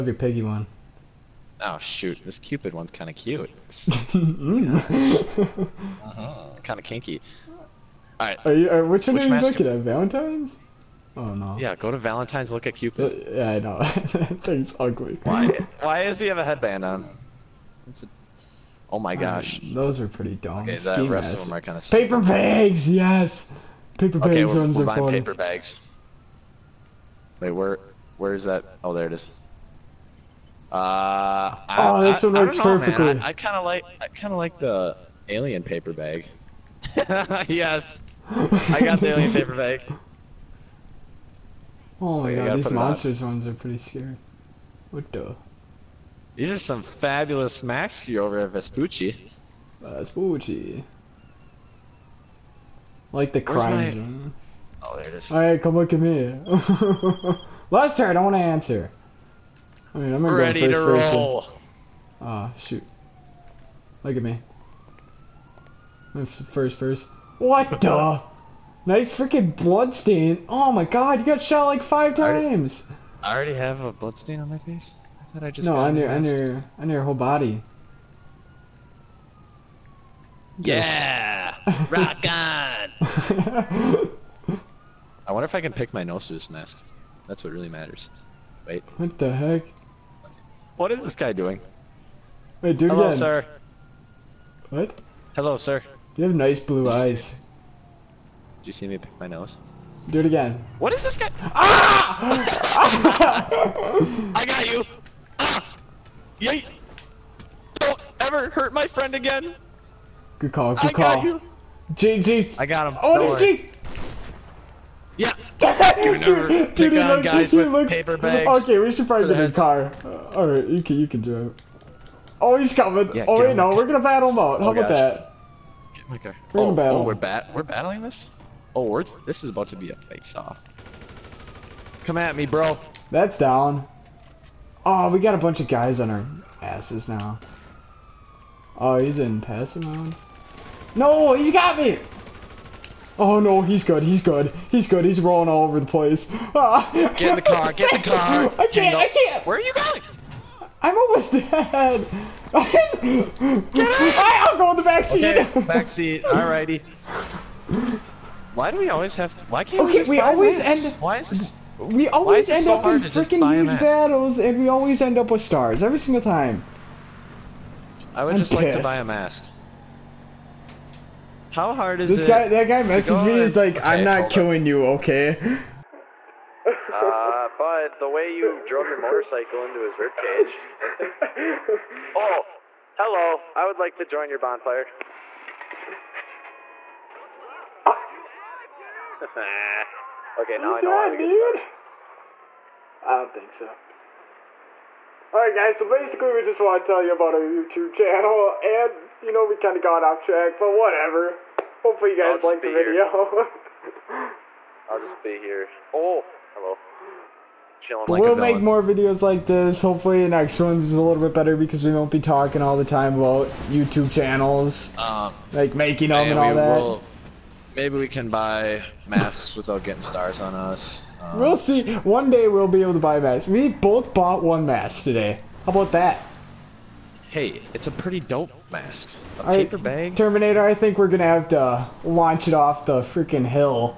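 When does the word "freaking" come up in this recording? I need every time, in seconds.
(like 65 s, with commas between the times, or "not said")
69 s, 163 s, 233 s.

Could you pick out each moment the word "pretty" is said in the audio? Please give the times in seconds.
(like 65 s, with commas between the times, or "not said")
20 s, 43 s, 227 s.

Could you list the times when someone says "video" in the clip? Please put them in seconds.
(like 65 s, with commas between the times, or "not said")
202 s, 208 s.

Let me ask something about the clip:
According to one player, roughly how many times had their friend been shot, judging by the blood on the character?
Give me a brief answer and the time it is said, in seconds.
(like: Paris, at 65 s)
5, at 71 s.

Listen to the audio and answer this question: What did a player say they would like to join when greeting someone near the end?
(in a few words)
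Bonfire.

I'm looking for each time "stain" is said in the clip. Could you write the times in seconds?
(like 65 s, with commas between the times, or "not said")
69 s, 74 s.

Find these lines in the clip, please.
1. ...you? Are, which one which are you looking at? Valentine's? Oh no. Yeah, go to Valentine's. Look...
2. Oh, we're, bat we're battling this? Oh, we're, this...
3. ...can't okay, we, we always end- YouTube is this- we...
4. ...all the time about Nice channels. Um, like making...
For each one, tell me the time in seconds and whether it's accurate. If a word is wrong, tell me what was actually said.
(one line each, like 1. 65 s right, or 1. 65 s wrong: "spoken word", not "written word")
1. 8 s right
2. 127 s right
3. 159 s wrong: "Why", not "YouTube"
4. 212 s wrong: "YouTube", not "Nice".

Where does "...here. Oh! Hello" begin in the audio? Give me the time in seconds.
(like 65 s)
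205 s.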